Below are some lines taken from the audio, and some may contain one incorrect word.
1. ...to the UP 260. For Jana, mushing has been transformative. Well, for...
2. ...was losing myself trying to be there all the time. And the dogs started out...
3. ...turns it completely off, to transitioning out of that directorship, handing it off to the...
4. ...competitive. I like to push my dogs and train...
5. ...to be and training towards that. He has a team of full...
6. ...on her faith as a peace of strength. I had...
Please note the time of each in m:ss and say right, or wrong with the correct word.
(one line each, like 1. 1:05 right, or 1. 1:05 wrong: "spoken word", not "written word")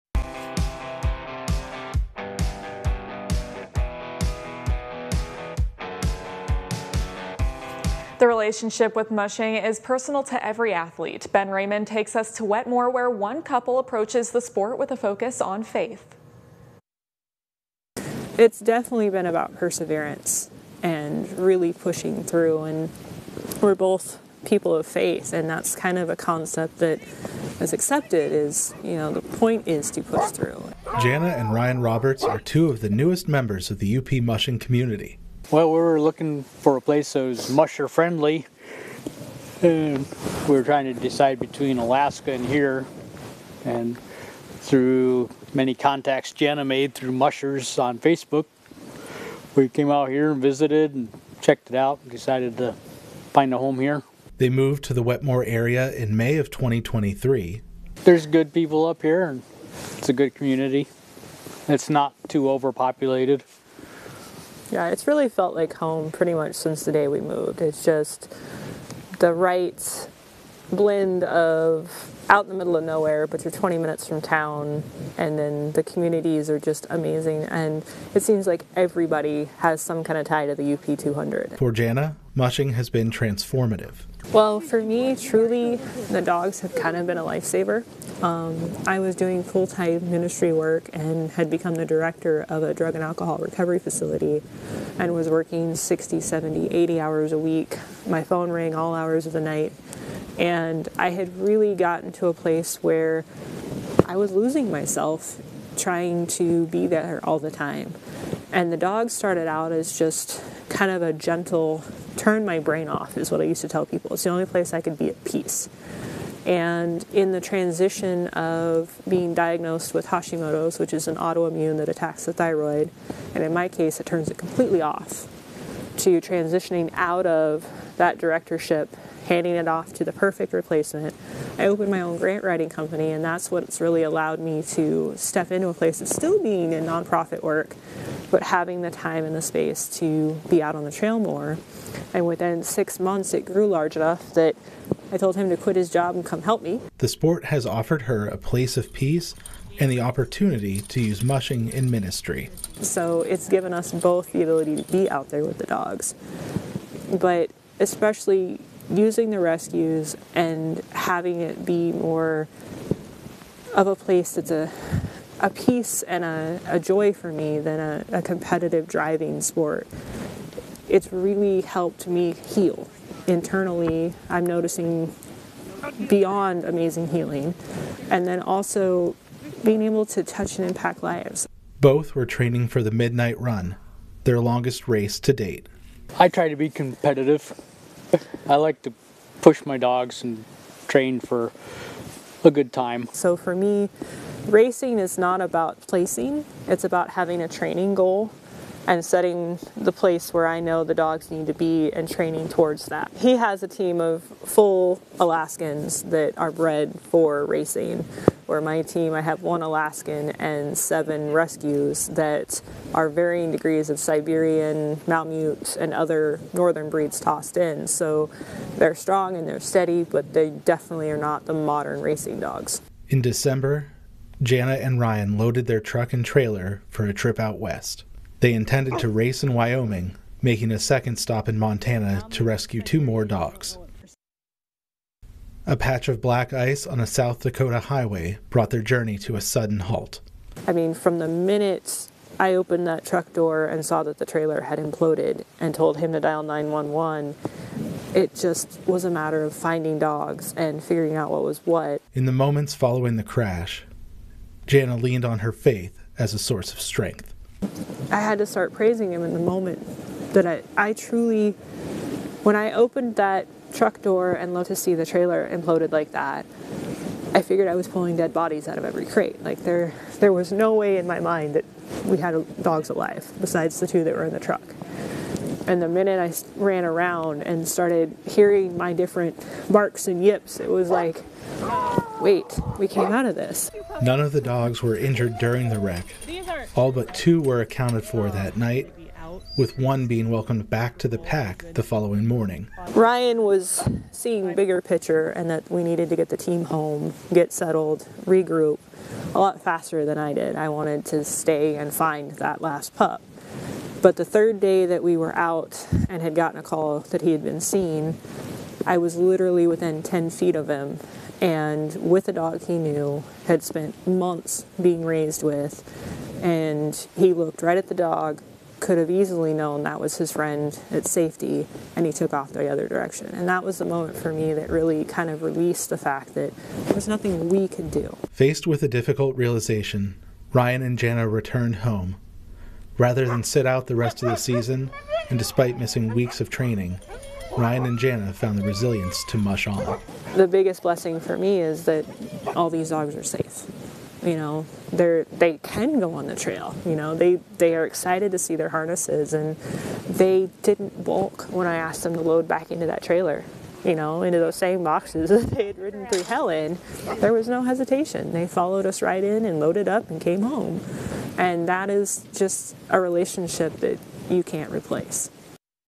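1. 1:20 wrong: "200", not "260"
2. 1:44 right
3. 2:04 right
4. 3:06 right
5. 3:21 right
6. 4:15 wrong: "source", not "peace".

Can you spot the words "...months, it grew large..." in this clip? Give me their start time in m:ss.
2:22.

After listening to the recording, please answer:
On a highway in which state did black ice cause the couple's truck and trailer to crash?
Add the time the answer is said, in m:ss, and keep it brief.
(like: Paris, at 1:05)
South Dakota, at 3:57.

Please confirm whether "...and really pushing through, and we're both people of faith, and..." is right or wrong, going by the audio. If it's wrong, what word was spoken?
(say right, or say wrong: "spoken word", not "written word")
right.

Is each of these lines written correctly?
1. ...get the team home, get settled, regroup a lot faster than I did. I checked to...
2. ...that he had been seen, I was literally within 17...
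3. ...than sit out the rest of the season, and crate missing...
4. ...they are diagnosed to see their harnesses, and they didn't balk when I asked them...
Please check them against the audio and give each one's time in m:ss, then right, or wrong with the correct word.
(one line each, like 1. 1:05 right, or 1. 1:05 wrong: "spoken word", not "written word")
1. 4:56 wrong: "wanted", not "checked"
2. 5:06 wrong: "10", not "17"
3. 5:33 wrong: "despite", not "crate"
4. 5:47 wrong: "excited", not "diagnosed".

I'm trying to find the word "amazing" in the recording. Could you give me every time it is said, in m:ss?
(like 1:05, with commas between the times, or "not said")
1:16, 2:56.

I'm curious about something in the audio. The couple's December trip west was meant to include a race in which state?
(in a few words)
Wyoming.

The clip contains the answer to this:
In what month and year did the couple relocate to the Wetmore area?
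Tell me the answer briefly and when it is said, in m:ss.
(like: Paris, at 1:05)
May 2023, at 0:56.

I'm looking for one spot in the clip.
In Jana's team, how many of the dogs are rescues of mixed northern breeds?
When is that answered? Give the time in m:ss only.
3:30.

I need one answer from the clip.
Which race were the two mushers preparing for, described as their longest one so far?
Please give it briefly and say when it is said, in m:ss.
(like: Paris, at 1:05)
Midnight Run, at 3:02.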